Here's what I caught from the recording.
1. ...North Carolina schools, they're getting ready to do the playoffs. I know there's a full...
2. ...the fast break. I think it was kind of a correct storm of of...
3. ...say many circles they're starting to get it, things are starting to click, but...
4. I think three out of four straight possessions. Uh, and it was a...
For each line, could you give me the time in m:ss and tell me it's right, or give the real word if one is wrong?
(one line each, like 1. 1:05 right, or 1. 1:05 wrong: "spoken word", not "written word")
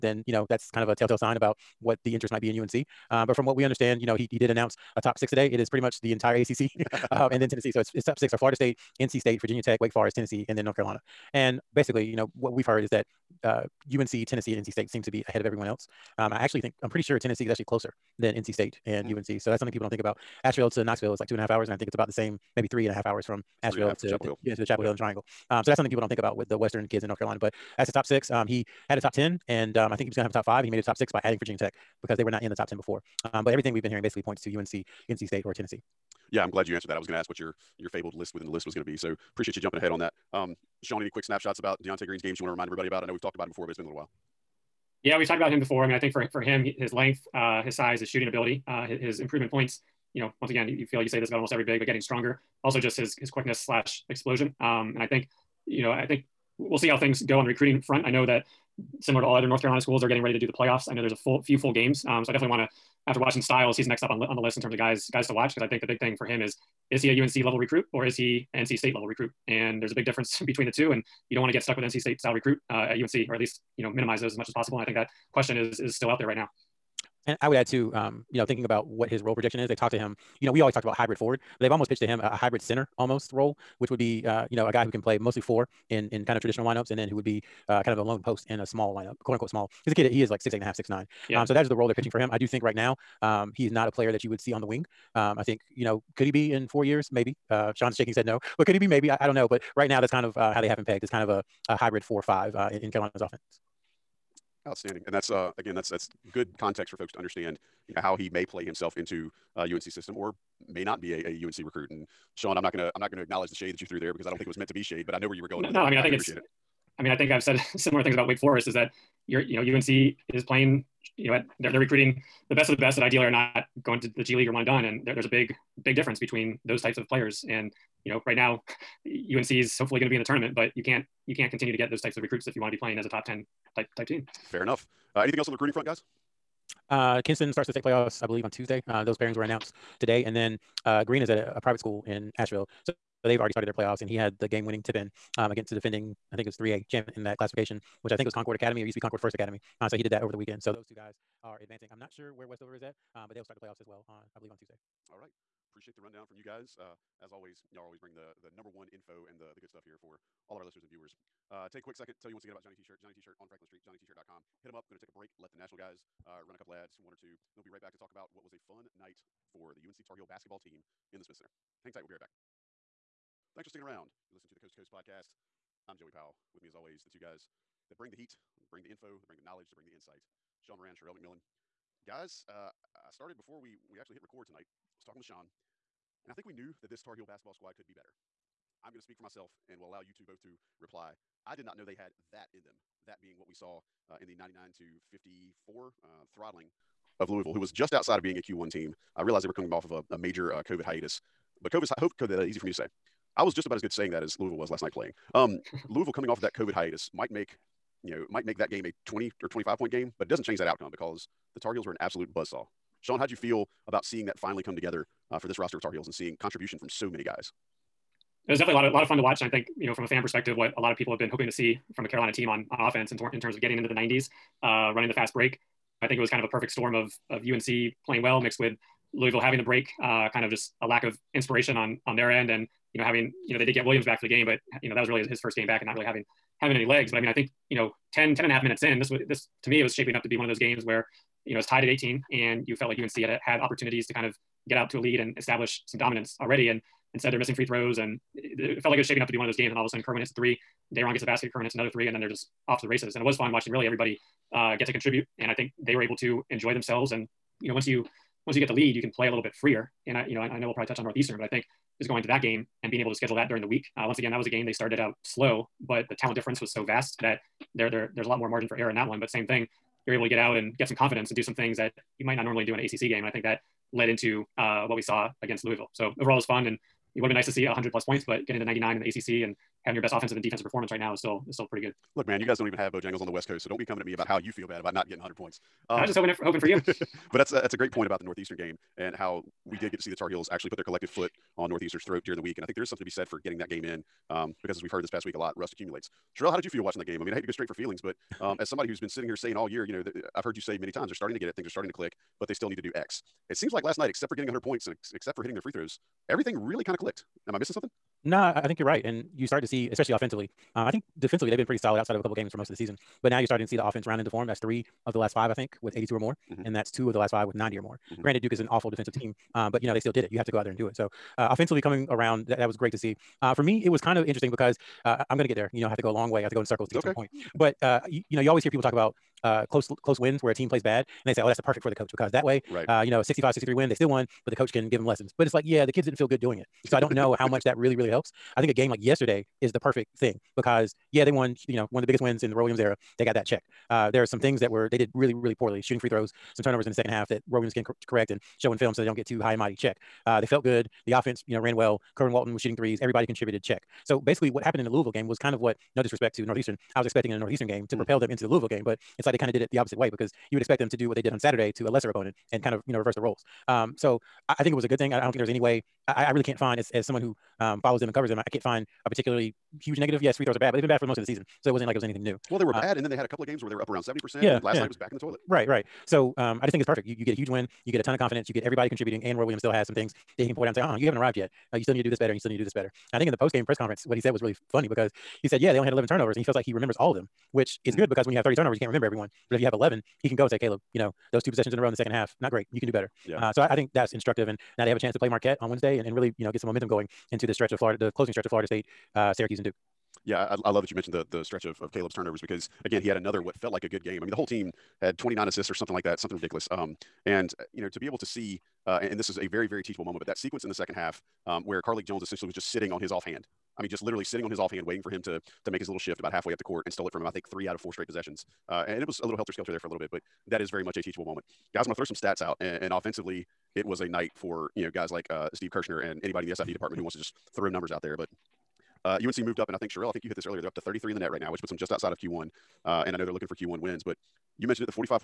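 1. 0:59 right
2. 3:45 wrong: "perfect", not "correct"
3. 5:00 wrong: "times", not "circles"
4. 6:57 right.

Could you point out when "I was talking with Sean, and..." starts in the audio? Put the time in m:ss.
3:04.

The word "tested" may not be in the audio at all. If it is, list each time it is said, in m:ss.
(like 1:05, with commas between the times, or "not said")
not said.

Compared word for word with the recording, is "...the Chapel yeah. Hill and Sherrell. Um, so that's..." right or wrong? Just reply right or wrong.
wrong.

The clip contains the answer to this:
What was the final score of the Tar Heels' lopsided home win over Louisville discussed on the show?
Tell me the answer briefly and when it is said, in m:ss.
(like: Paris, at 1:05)
99 to 54, at 3:14.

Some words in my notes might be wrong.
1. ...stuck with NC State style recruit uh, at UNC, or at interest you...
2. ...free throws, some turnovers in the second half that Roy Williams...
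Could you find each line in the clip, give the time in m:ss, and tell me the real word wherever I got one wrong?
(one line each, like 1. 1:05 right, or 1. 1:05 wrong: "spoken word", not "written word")
1. 1:11 wrong: "least", not "interest"
2. 5:45 right.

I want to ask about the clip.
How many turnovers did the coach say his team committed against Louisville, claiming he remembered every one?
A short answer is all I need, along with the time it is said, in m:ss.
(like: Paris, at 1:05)
11, at 6:25.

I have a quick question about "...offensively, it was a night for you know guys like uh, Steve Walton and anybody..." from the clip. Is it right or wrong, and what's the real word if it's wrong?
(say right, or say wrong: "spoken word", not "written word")
wrong: "Kirschner", not "Walton".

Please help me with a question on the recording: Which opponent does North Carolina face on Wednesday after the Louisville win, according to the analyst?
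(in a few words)
Marquette.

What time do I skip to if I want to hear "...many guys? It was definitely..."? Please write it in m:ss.
3:37.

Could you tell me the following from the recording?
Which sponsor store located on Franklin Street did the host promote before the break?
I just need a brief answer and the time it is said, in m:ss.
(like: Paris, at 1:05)
Johnny T-shirt, at 2:42.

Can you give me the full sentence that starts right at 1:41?
It's kind of a, a hybrid four or five uh, in, in, Carolina's offense.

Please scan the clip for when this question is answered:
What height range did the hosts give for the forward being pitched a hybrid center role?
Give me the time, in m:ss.
1:30.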